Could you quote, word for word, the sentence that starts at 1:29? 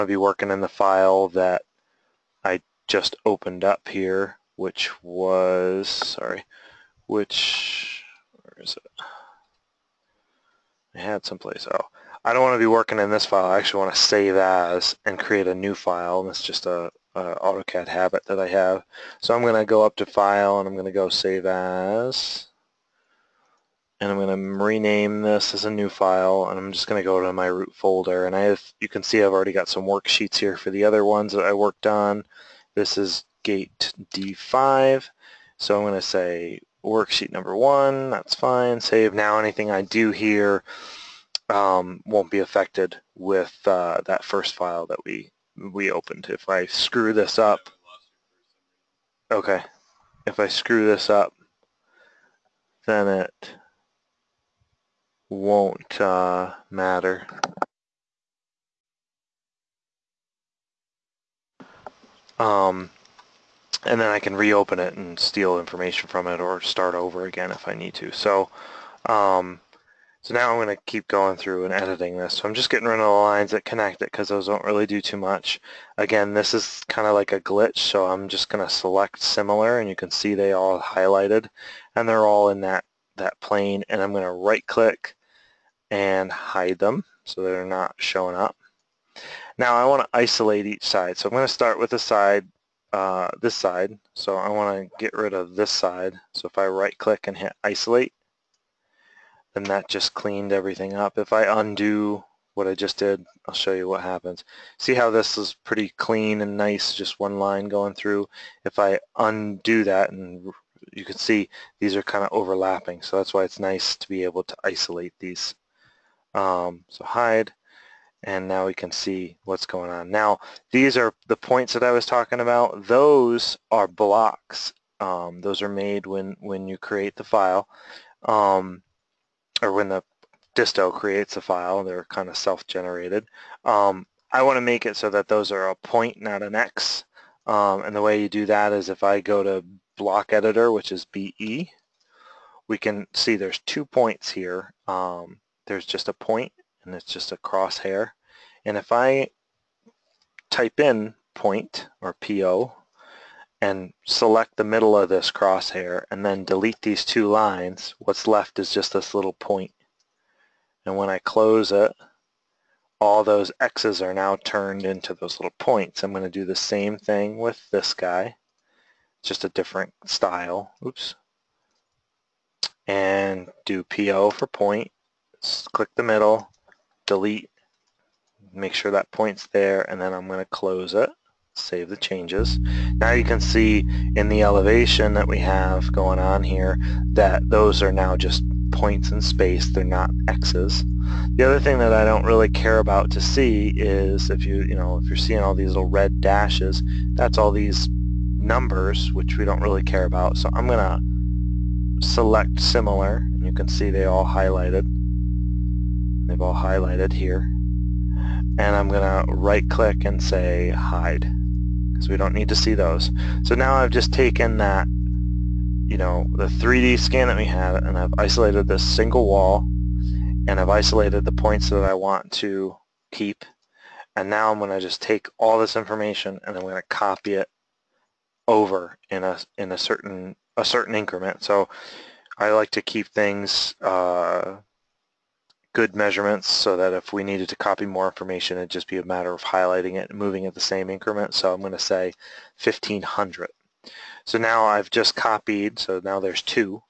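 Now I want to isolate each side.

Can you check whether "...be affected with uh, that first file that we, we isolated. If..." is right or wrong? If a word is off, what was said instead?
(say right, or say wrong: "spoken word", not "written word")
wrong: "opened", not "isolated".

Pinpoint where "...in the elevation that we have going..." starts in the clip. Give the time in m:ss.
3:04.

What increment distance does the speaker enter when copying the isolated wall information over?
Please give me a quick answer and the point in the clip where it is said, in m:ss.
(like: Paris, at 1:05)
1500, at 4:02.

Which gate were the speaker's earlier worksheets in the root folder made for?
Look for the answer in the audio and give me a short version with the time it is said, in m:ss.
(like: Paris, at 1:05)
D5, at 0:33.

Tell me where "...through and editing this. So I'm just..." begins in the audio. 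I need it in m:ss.
1:11.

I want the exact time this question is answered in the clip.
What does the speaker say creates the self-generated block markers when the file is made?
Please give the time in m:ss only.
2:09.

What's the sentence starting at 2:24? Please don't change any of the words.
Um, there's just a point and it's just a crosshair.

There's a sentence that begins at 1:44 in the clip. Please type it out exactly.
See how this is pretty clean and nice, just one line going through.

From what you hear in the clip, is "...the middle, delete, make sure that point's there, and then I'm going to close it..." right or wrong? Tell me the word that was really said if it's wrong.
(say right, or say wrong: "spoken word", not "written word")
right.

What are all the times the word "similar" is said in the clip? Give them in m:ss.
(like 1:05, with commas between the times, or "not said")
1:19, 3:22.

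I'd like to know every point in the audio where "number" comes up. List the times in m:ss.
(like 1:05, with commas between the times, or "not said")
0:37, 3:18.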